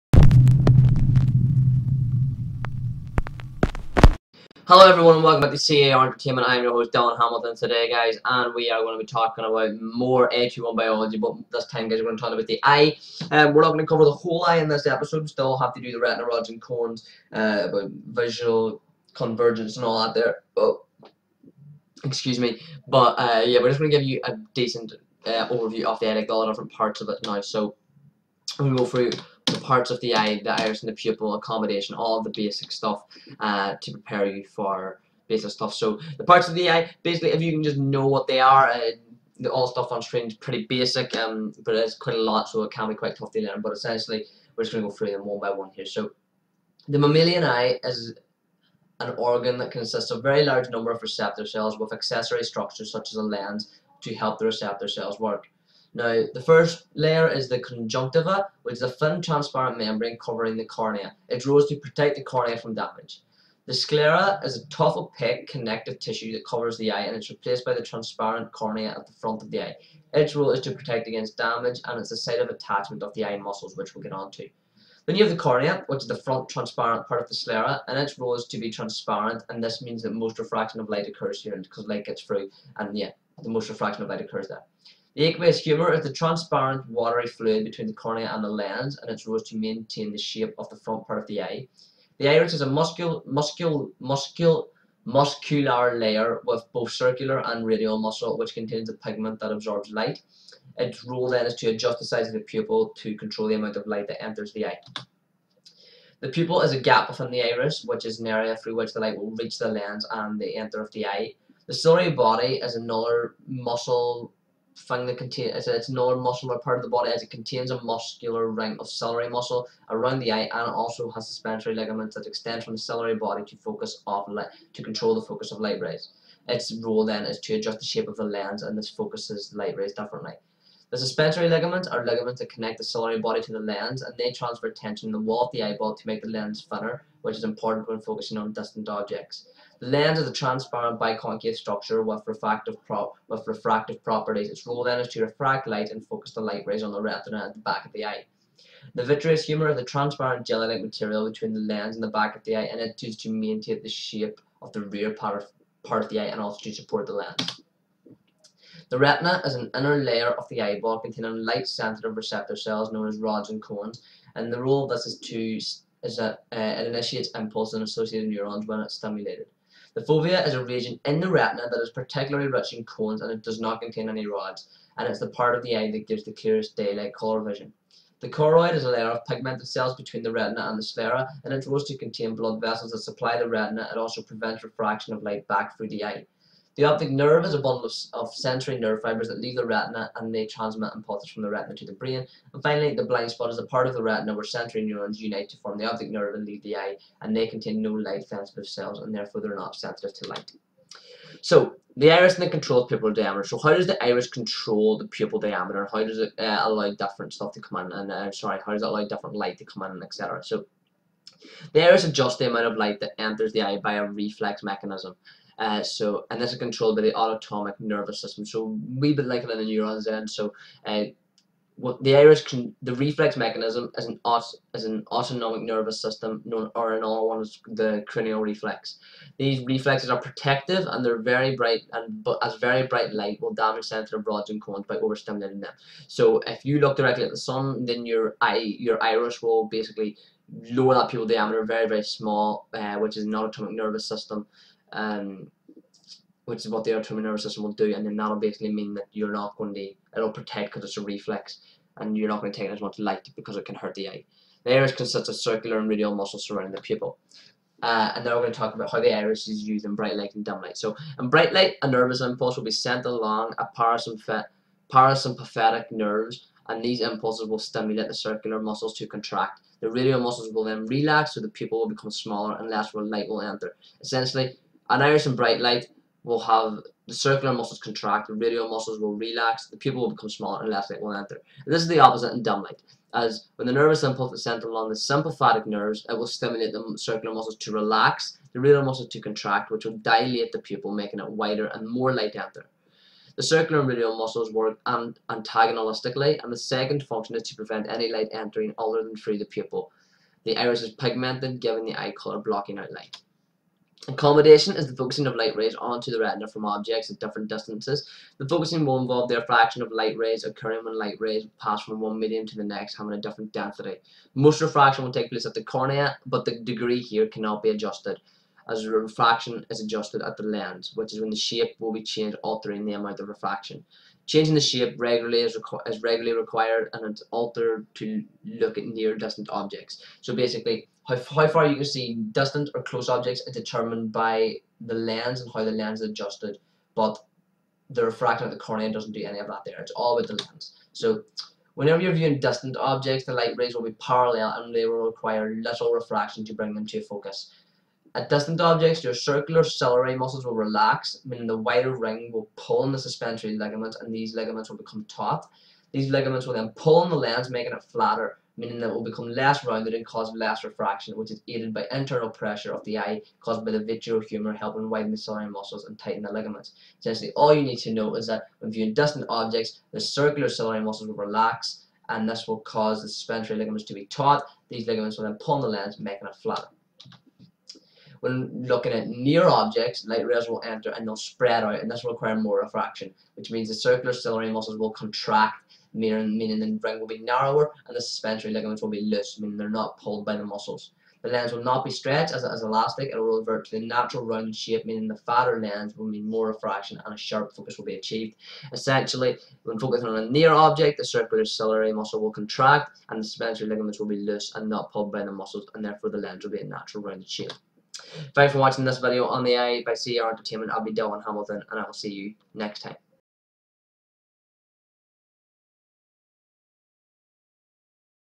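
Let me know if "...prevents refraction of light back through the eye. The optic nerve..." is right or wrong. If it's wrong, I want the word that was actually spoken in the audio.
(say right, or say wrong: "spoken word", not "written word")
right.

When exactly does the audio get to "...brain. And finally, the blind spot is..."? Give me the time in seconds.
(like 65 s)
191 s.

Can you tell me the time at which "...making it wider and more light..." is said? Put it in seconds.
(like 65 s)
290 s.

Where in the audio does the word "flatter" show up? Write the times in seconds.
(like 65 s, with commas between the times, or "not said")
357 s, 376 s.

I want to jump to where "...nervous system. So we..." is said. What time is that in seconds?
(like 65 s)
217 s.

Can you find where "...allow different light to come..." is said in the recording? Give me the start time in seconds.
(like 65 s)
208 s.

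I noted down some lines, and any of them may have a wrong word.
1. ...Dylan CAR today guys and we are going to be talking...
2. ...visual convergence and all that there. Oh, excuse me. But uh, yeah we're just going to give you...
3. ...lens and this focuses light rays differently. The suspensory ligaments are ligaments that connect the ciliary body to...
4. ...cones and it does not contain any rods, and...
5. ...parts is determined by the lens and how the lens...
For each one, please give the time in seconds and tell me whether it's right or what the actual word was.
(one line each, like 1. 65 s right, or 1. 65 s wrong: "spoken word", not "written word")
1. 6 s wrong: "Hamilton", not "CAR"
2. 18 s right
3. 128 s right
4. 172 s right
5. 333 s wrong: "objects", not "parts".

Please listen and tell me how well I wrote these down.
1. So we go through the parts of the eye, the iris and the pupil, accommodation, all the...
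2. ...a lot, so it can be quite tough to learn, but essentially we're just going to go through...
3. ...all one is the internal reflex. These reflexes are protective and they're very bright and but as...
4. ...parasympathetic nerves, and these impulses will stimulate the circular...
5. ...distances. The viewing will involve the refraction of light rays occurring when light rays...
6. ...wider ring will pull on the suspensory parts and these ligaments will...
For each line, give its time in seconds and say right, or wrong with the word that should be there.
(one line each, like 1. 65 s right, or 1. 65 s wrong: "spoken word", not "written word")
1. 27 s right
2. 42 s right
3. 227 s wrong: "cranial", not "internal"
4. 264 s right
5. 307 s wrong: "focusing", not "viewing"
6. 351 s wrong: "ligaments", not "parts".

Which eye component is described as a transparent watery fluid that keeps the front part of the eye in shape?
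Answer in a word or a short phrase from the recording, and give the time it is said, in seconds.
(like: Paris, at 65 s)
aqueous humor, at 85 s.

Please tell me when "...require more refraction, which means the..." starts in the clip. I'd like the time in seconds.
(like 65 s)
382 s.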